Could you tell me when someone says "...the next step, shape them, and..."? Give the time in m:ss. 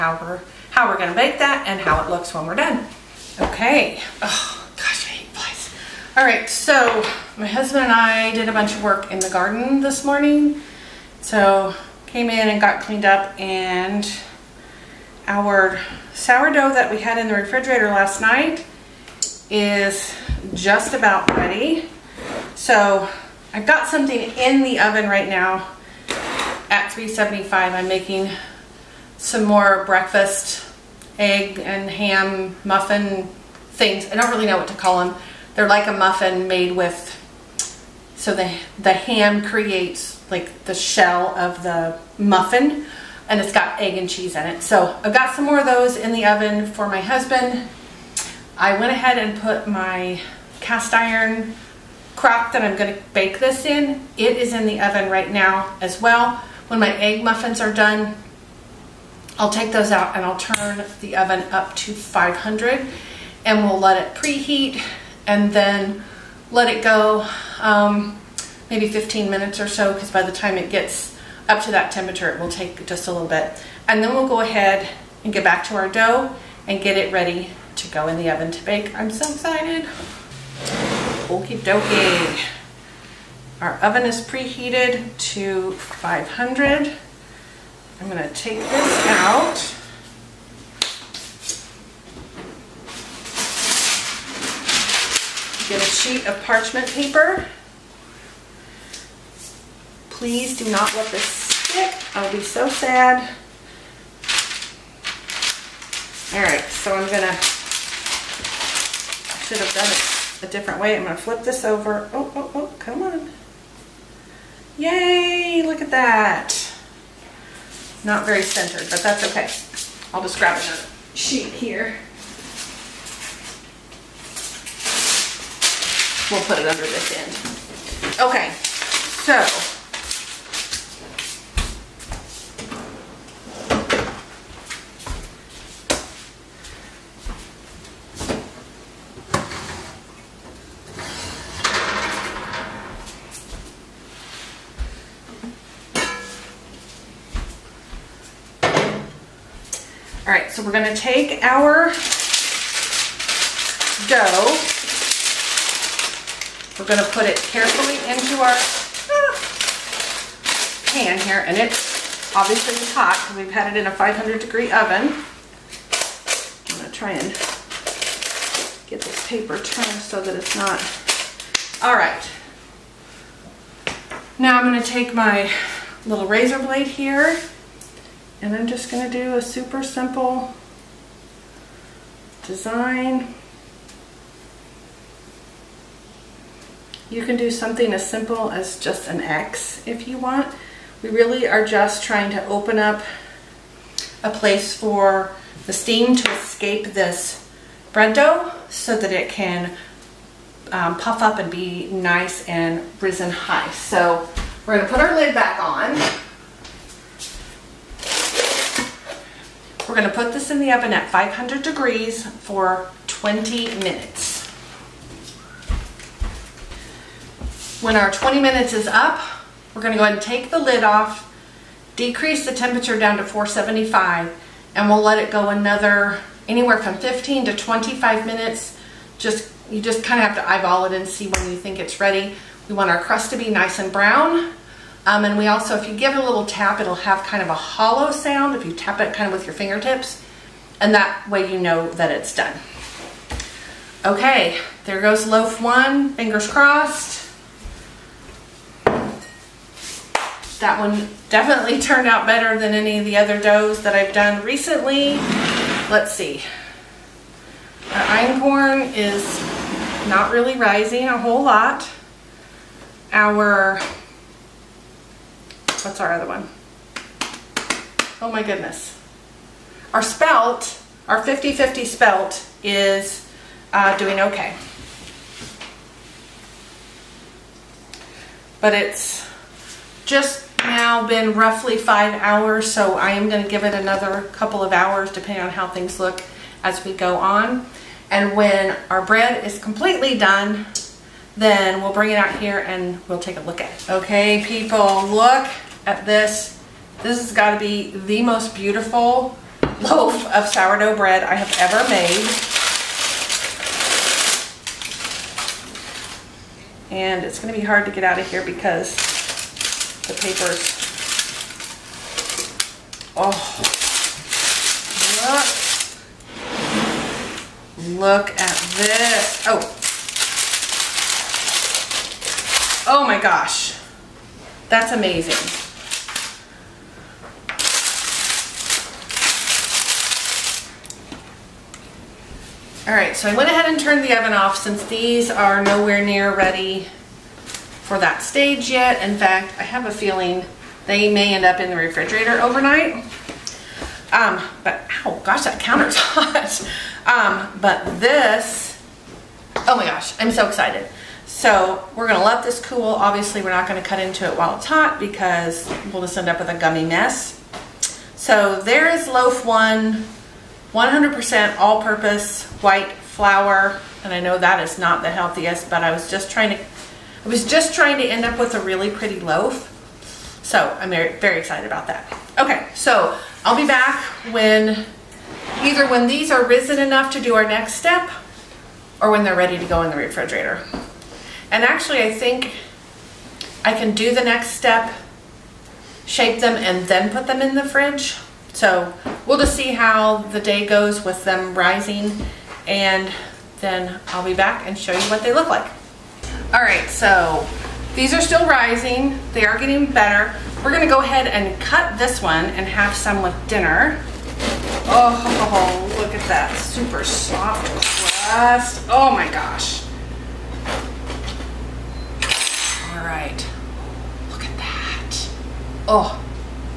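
6:24.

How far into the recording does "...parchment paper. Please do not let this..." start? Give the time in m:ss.
1:36.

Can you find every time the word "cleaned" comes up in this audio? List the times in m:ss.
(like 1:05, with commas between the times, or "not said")
0:12.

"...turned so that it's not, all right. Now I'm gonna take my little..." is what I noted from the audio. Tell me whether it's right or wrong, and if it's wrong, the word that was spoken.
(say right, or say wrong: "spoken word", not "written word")
right.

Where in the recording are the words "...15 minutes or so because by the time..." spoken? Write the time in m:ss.
1:08.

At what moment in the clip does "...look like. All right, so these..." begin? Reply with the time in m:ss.
6:35.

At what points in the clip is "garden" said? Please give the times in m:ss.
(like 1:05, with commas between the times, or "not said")
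0:09.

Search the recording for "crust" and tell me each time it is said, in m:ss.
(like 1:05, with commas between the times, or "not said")
3:53, 6:48.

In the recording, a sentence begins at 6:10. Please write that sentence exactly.
So I'm very, very excited about that.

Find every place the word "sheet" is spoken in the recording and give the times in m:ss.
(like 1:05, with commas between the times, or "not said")
1:35, 2:01.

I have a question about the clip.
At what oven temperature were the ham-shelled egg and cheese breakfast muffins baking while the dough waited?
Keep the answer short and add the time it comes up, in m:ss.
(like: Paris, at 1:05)
375, at 0:26.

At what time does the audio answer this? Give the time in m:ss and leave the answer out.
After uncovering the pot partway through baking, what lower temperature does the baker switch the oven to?
3:43.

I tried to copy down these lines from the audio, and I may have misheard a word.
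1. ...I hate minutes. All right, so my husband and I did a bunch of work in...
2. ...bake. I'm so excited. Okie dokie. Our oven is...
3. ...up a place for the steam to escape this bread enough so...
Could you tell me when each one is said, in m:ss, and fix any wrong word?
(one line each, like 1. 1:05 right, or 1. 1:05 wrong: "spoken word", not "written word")
1. 0:05 wrong: "flies", not "minutes"
2. 1:18 right
3. 3:12 wrong: "dough", not "enough".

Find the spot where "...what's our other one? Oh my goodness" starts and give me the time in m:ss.
4:25.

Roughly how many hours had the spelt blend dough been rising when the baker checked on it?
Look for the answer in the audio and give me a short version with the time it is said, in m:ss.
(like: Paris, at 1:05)
5, at 4:41.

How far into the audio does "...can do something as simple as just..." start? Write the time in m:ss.
3:07.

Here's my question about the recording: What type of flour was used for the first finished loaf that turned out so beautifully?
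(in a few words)
all-purpose white flour.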